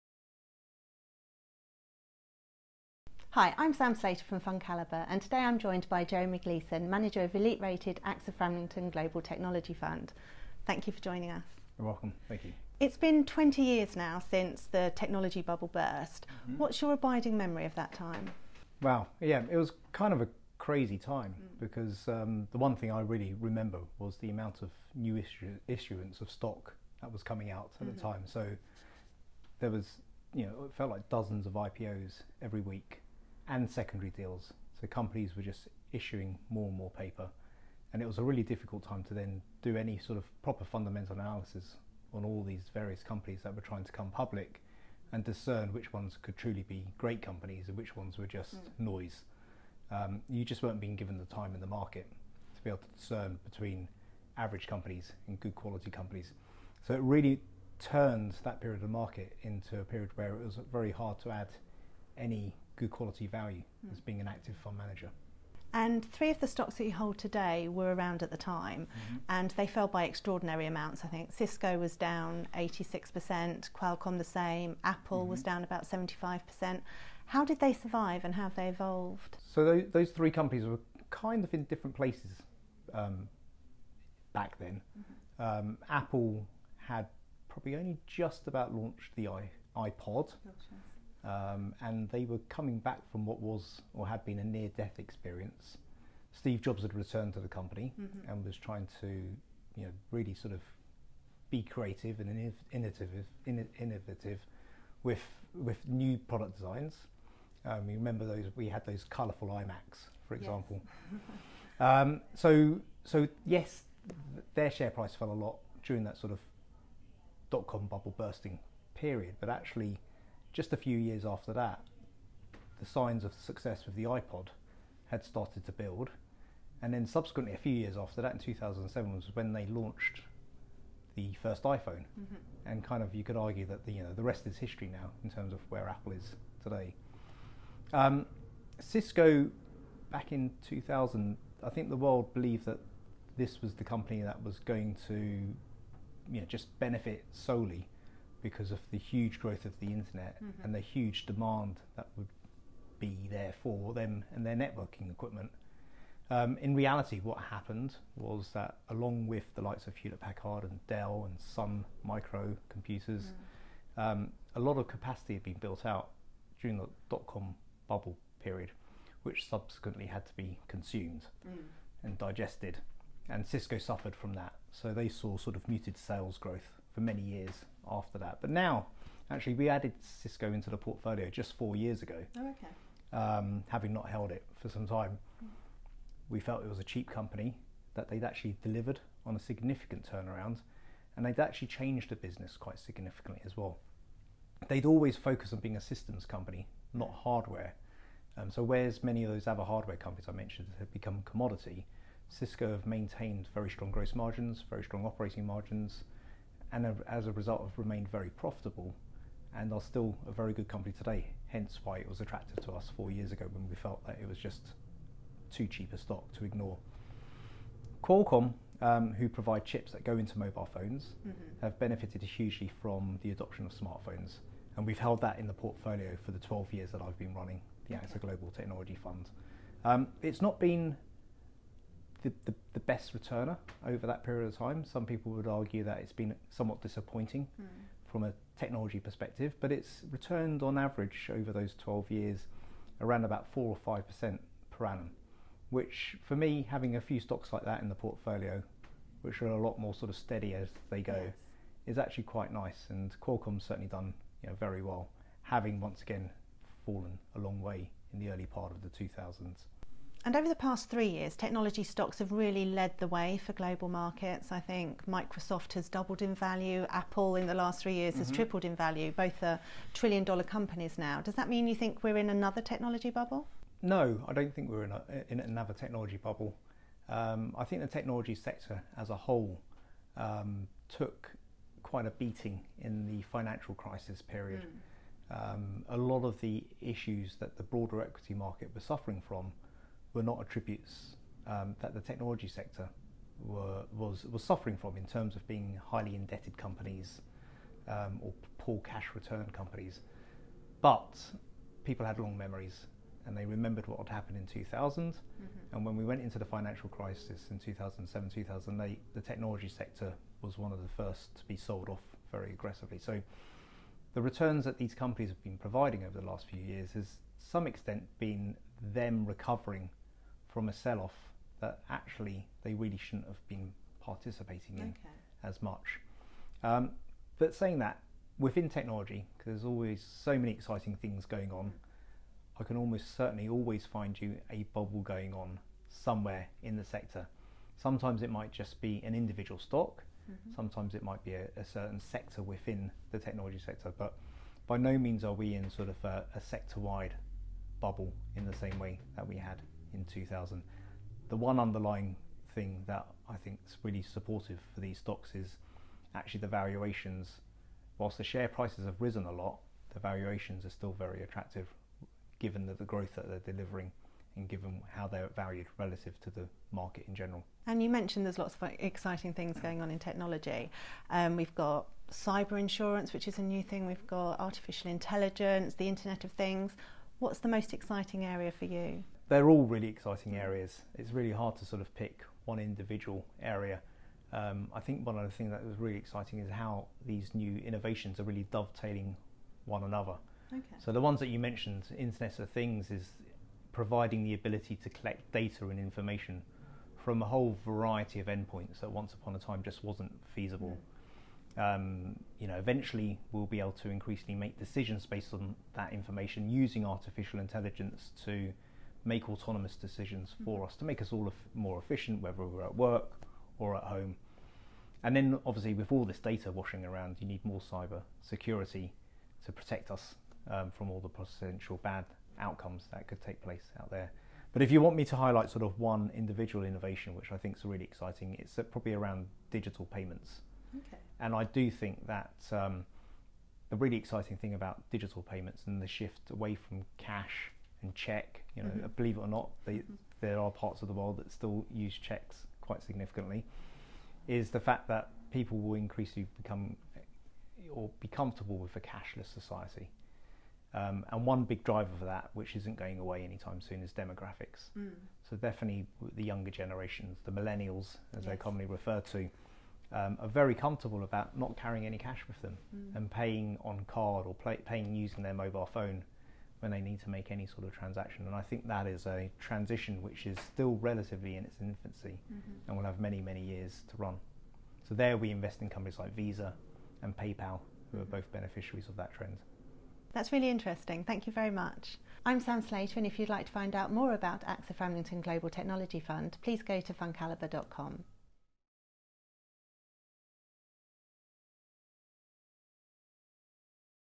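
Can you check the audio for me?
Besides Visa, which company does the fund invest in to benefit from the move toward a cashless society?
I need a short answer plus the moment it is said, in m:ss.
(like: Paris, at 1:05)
PayPal, at 7:57.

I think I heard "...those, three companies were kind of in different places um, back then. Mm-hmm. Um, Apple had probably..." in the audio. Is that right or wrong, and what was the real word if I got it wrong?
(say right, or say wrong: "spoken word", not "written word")
right.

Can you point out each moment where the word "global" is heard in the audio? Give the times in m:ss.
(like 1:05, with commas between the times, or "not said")
0:08, 3:48, 4:23, 8:05.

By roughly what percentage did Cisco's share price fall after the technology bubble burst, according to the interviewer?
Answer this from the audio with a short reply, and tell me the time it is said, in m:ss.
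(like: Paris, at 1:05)
86%, at 1:12.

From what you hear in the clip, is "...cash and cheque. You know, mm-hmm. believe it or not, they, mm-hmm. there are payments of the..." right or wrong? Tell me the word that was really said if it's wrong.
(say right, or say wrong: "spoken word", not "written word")
wrong: "parts", not "payments".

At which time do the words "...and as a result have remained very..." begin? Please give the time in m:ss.
3:26.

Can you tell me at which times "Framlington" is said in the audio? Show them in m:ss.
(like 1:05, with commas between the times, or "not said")
0:08, 8:04.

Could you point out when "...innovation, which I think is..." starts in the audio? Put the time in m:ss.
7:06.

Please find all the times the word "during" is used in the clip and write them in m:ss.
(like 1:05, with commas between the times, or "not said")
1:55, 2:46.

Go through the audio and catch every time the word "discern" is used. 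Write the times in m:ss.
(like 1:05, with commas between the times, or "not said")
0:45, 0:52.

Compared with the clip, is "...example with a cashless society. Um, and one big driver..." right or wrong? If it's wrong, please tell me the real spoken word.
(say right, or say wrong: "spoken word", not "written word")
wrong: "comfortable", not "example".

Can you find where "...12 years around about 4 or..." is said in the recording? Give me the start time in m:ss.
4:01.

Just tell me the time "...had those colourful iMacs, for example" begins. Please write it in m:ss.
1:48.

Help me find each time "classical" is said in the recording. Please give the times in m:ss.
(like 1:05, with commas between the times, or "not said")
not said.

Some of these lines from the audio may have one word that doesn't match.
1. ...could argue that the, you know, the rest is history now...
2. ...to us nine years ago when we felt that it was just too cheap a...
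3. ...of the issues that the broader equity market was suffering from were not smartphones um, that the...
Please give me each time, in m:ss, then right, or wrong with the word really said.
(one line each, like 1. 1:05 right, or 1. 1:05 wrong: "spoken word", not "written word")
1. 2:13 right
2. 3:32 wrong: "four", not "nine"
3. 4:46 wrong: "attributes", not "smartphones".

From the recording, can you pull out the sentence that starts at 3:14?
They'd always focus on being a systems company, not hardware.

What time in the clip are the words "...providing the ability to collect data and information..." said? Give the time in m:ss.
6:33.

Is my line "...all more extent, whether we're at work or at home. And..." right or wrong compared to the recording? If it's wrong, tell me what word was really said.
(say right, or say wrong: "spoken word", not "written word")
wrong: "efficient", not "extent".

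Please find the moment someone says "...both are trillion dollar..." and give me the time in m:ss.
4:29.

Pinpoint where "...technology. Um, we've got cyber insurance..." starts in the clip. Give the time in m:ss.
6:09.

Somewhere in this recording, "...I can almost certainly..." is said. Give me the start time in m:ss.
5:32.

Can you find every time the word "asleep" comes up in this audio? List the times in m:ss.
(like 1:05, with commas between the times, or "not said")
not said.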